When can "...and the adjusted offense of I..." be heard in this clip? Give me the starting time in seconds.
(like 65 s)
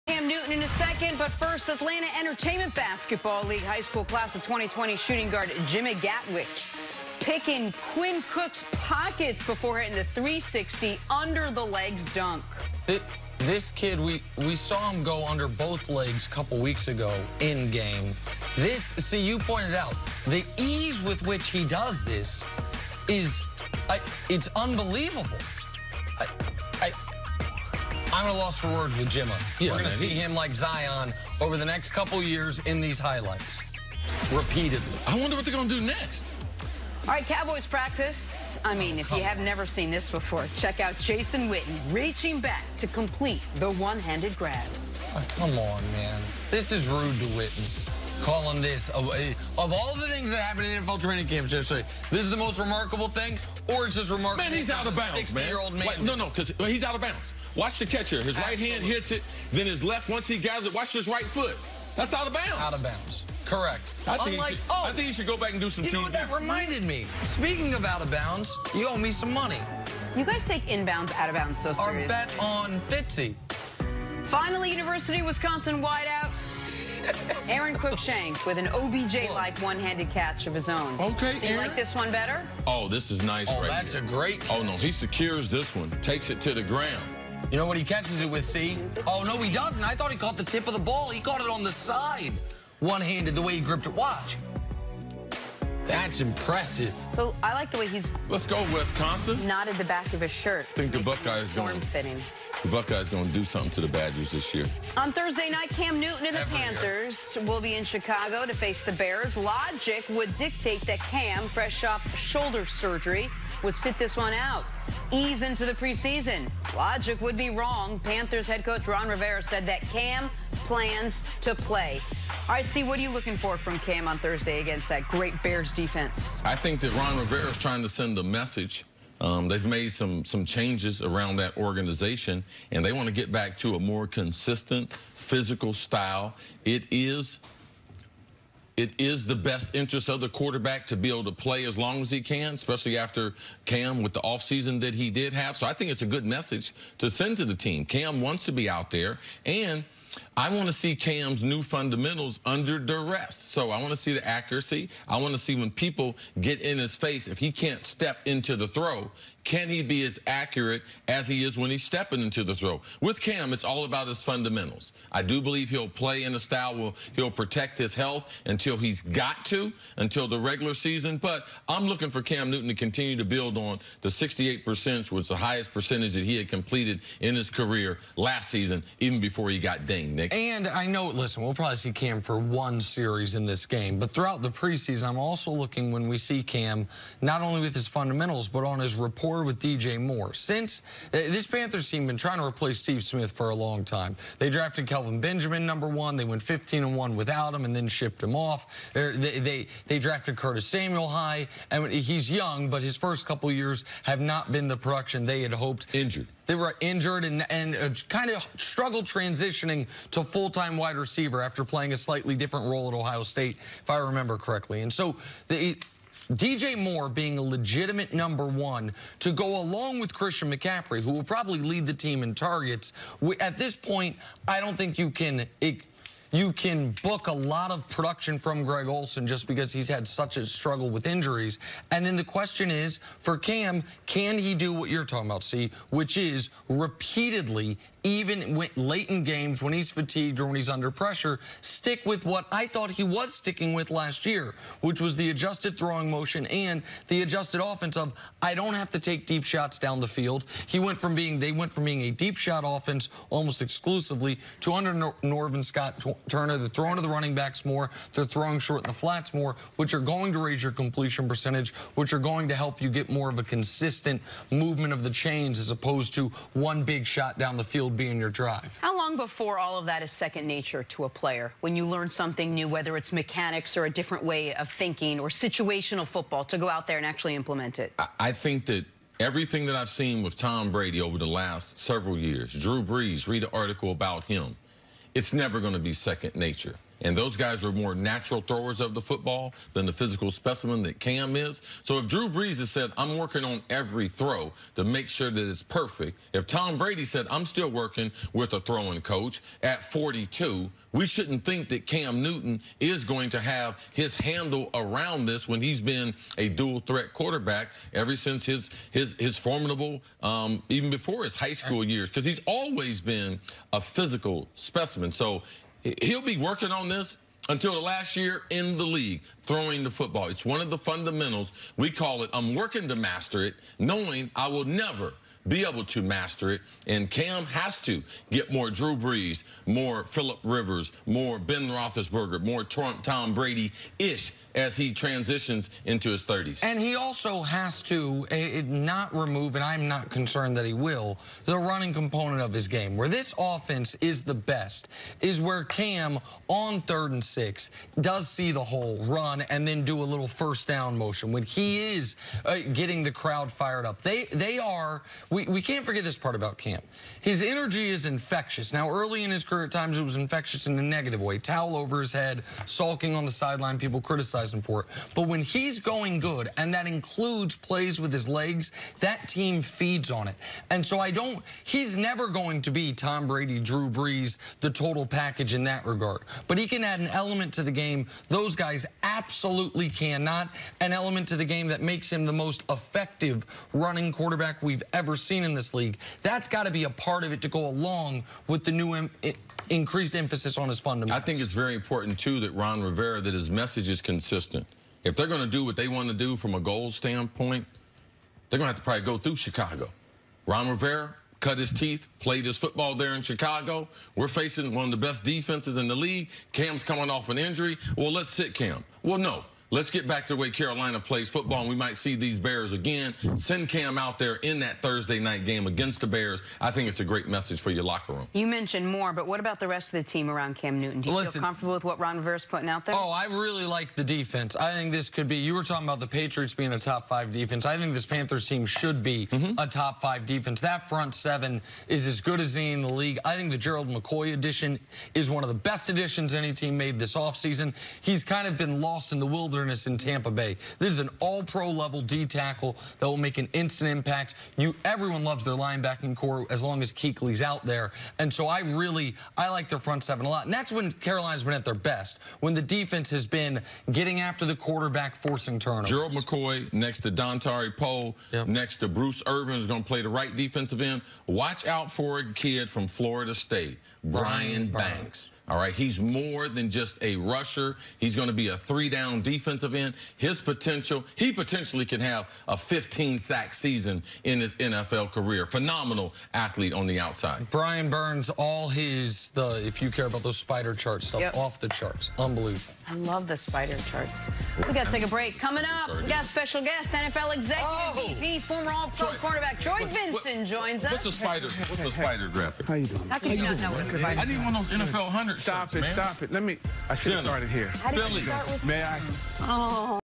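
246 s.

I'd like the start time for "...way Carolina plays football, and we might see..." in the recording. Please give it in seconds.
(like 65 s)
410 s.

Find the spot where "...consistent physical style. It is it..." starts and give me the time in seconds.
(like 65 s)
134 s.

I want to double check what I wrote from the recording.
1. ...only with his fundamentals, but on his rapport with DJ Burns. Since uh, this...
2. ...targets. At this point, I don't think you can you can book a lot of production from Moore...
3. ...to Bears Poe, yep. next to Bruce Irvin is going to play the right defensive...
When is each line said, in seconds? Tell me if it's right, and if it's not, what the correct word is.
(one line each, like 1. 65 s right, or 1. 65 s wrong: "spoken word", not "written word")
1. 187 s wrong: "Moore", not "Burns"
2. 222 s wrong: "Greg", not "Moore"
3. 457 s wrong: "Dontari", not "Bears".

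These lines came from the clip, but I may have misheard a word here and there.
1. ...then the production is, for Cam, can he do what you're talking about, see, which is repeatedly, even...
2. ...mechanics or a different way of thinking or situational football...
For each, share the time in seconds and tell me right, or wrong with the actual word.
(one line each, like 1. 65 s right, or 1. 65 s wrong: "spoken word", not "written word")
1. 232 s wrong: "question", not "production"
2. 273 s right.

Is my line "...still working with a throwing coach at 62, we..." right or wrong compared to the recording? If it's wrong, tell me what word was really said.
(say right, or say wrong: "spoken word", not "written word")
wrong: "42", not "62".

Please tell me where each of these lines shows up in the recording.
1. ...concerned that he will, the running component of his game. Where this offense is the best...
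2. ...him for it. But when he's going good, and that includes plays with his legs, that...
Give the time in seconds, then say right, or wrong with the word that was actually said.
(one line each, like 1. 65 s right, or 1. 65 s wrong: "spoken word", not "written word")
1. 340 s right
2. 364 s right.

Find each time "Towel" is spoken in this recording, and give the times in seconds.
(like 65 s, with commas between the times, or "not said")
361 s.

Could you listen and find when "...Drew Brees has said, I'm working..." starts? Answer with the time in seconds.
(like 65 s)
292 s.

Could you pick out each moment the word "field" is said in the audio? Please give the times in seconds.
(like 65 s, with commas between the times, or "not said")
250 s, 267 s.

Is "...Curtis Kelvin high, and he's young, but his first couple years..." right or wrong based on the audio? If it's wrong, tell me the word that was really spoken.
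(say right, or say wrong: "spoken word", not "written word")
wrong: "Samuel", not "Kelvin".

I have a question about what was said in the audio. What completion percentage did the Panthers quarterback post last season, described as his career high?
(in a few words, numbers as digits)
68%.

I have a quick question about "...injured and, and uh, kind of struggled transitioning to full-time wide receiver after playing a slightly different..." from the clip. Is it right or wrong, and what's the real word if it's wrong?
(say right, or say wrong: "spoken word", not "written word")
right.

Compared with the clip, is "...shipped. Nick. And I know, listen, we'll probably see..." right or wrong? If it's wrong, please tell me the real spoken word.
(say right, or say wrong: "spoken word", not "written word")
wrong: "dinged", not "shipped".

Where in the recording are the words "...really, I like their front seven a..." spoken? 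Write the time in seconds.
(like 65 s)
448 s.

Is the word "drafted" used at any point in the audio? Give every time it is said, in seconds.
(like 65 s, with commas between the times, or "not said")
194 s, 199 s.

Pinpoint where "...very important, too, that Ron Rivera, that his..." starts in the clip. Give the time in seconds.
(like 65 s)
391 s.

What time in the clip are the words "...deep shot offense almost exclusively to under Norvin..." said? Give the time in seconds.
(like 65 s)
252 s.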